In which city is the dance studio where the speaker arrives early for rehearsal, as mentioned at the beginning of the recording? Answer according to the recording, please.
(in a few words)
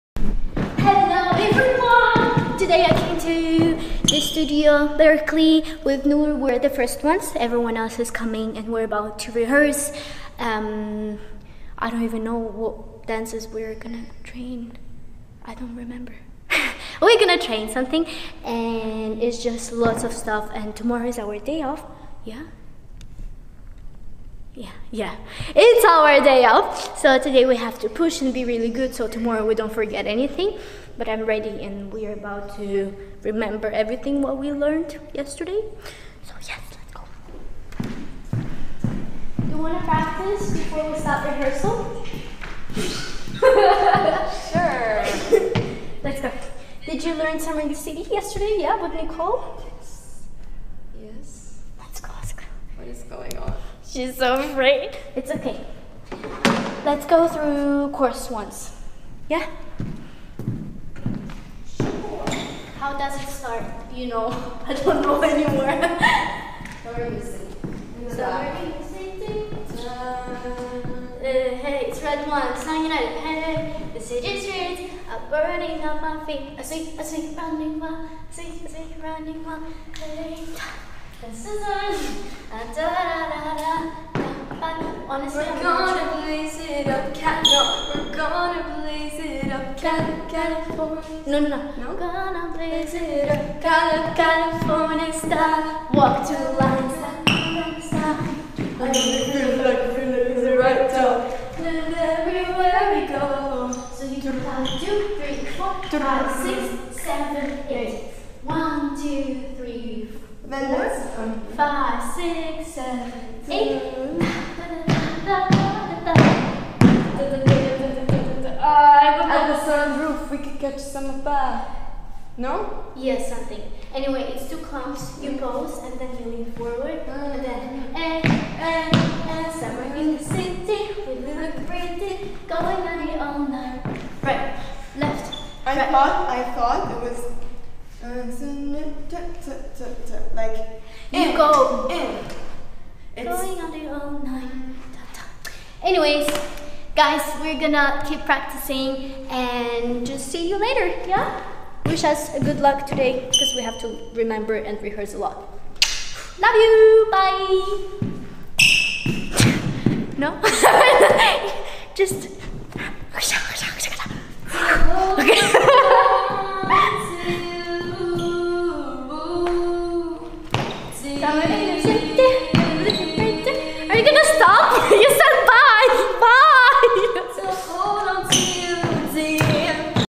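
Berkeley.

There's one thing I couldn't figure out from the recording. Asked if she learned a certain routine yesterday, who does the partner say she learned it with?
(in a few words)
Nicole.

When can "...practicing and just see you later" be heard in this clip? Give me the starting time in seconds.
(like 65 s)
148 s.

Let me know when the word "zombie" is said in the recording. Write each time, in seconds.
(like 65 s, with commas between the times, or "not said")
not said.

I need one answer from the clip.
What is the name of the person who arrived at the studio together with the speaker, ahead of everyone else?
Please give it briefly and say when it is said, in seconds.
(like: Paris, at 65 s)
Nour, at 6 s.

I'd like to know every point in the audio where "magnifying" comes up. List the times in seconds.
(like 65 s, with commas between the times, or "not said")
not said.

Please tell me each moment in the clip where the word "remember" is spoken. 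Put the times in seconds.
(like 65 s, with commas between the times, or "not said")
15 s, 33 s, 154 s.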